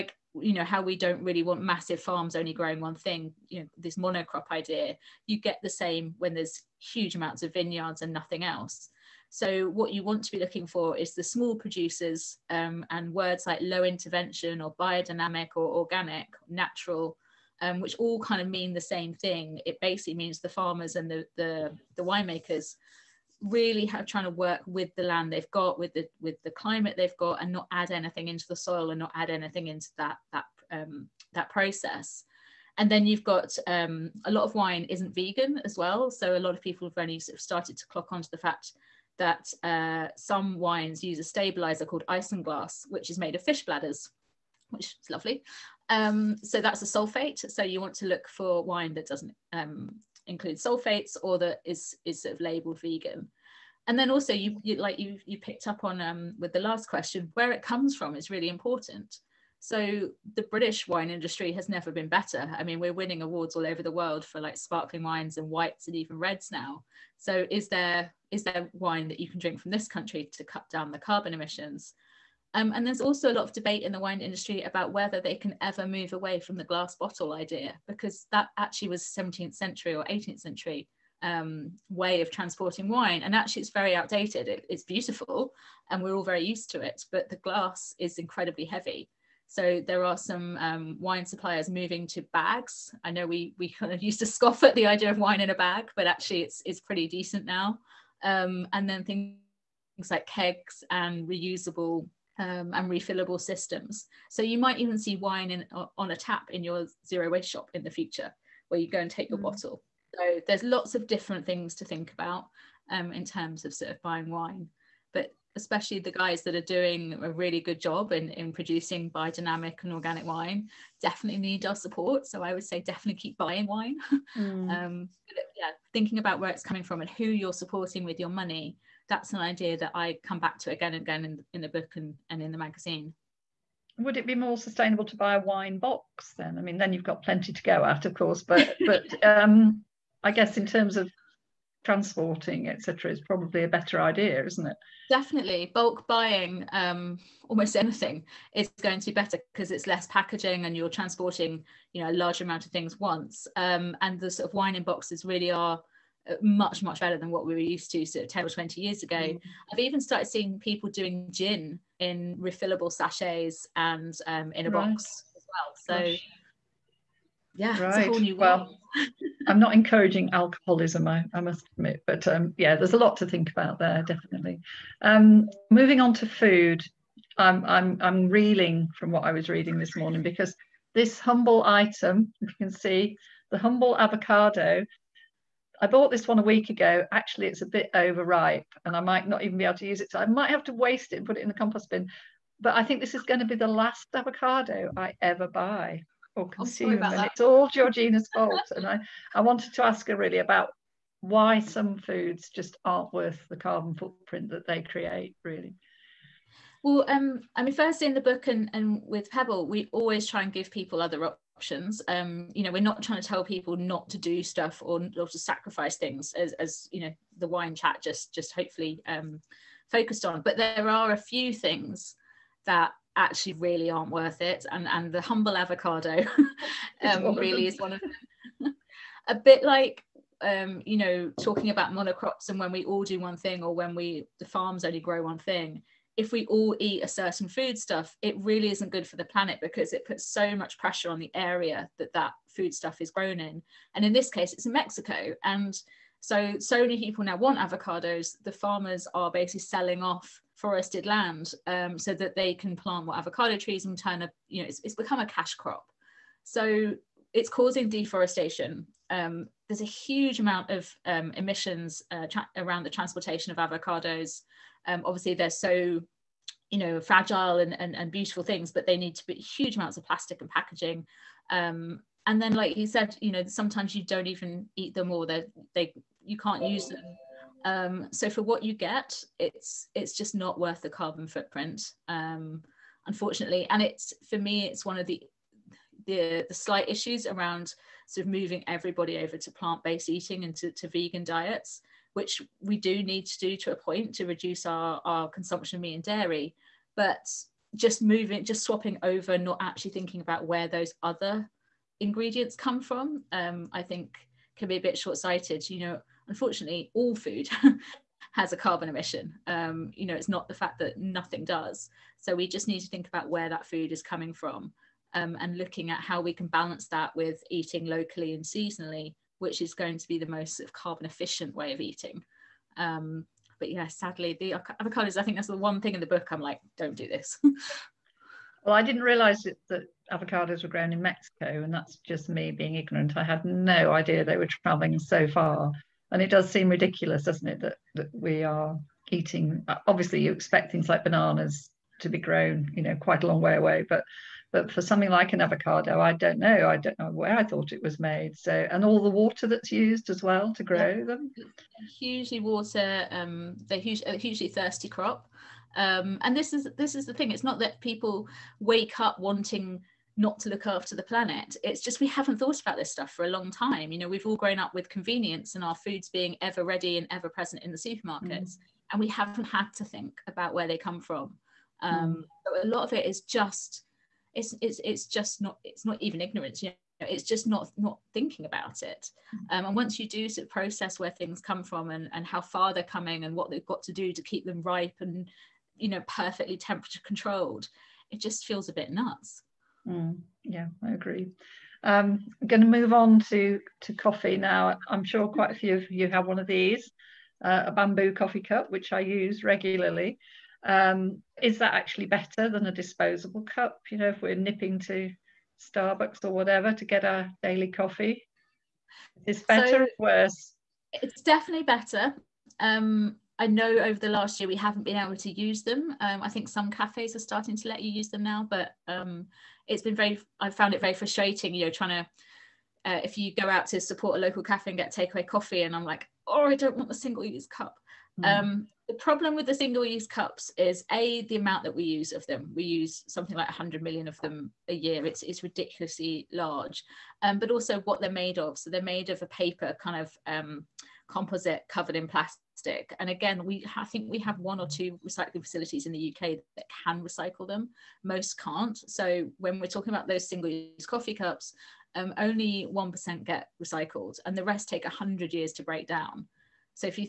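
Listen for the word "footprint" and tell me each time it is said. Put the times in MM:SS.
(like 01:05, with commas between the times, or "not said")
03:23, 04:41.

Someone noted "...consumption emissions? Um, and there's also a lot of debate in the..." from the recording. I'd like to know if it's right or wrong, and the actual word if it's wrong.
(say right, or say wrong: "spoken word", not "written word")
wrong: "carbon", not "consumption".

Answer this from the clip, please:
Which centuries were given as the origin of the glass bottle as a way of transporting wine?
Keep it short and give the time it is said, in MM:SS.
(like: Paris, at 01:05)
17th or 18th century, at 01:19.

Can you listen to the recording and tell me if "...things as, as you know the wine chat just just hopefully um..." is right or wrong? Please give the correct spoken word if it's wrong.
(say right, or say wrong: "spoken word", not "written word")
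right.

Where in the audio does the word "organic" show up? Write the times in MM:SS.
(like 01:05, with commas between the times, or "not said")
00:15, 01:59.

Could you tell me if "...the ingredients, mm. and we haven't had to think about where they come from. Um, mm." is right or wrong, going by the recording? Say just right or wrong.
wrong.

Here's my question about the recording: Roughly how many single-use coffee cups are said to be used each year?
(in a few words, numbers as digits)
100 million.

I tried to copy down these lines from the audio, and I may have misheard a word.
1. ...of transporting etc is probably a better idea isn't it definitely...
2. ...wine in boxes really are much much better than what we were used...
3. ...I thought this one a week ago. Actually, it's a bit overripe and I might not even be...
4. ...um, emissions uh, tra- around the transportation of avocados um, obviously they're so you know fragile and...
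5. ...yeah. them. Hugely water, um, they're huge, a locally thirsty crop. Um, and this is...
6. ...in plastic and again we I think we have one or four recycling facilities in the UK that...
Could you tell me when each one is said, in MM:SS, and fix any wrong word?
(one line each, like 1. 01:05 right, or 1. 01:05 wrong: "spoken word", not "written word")
1. 02:20 right
2. 02:34 right
3. 03:05 wrong: "bought", not "thought"
4. 04:21 right
5. 05:50 wrong: "hugely", not "locally"
6. 07:21 wrong: "two", not "four".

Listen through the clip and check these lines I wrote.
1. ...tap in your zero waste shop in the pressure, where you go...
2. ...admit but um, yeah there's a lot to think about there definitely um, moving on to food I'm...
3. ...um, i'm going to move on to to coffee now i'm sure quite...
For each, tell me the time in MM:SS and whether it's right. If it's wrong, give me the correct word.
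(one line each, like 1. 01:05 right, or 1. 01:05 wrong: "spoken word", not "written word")
1. 01:46 wrong: "future", not "pressure"
2. 02:51 right
3. 06:31 right.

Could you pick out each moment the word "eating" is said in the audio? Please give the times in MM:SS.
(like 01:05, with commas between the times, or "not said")
04:50, 05:17, 05:21, 05:39.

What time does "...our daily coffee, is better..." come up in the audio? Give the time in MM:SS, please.
06:47.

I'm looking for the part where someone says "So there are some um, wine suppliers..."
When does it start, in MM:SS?
01:29.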